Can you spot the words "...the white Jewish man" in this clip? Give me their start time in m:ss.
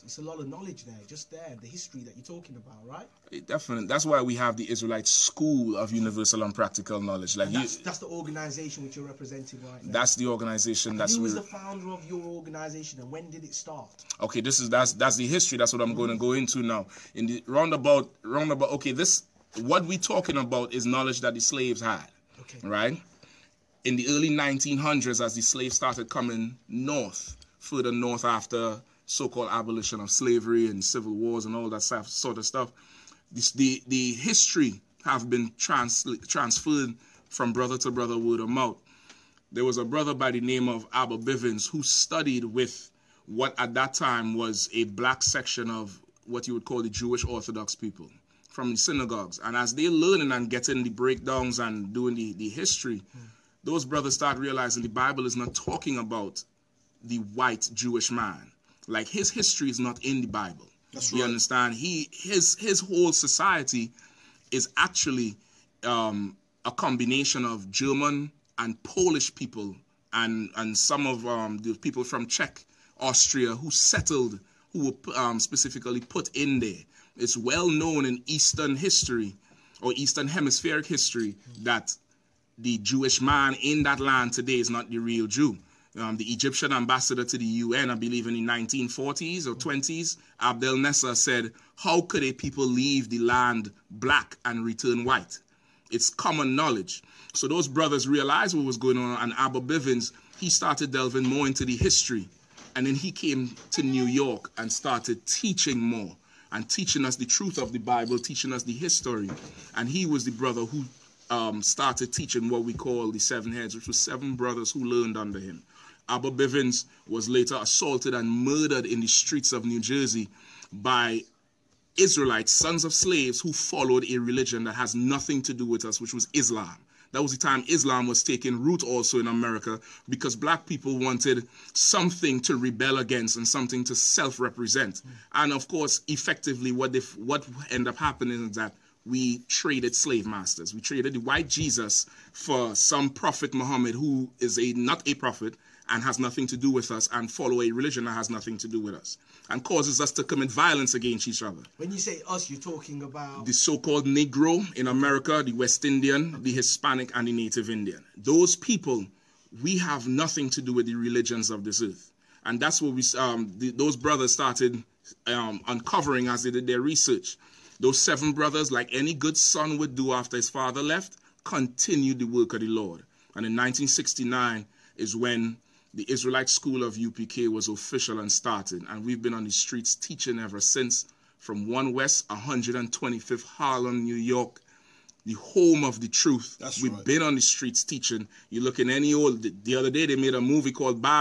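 0:57.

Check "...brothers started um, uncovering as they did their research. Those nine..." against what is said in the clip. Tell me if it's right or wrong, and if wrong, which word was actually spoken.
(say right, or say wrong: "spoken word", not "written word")
wrong: "seven", not "nine".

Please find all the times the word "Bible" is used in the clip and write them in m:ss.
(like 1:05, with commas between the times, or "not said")
0:54, 1:00, 1:47.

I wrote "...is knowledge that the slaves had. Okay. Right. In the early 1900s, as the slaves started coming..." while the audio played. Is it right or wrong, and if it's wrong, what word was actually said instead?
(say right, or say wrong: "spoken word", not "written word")
right.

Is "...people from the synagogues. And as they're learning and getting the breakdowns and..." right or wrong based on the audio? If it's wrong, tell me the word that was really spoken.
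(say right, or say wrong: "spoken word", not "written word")
right.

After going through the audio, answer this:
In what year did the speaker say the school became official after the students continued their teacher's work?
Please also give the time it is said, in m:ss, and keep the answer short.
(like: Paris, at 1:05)
1969, at 2:53.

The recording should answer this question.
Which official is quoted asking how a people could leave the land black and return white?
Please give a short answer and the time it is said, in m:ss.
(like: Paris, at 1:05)
Abdel Nasser, at 1:30.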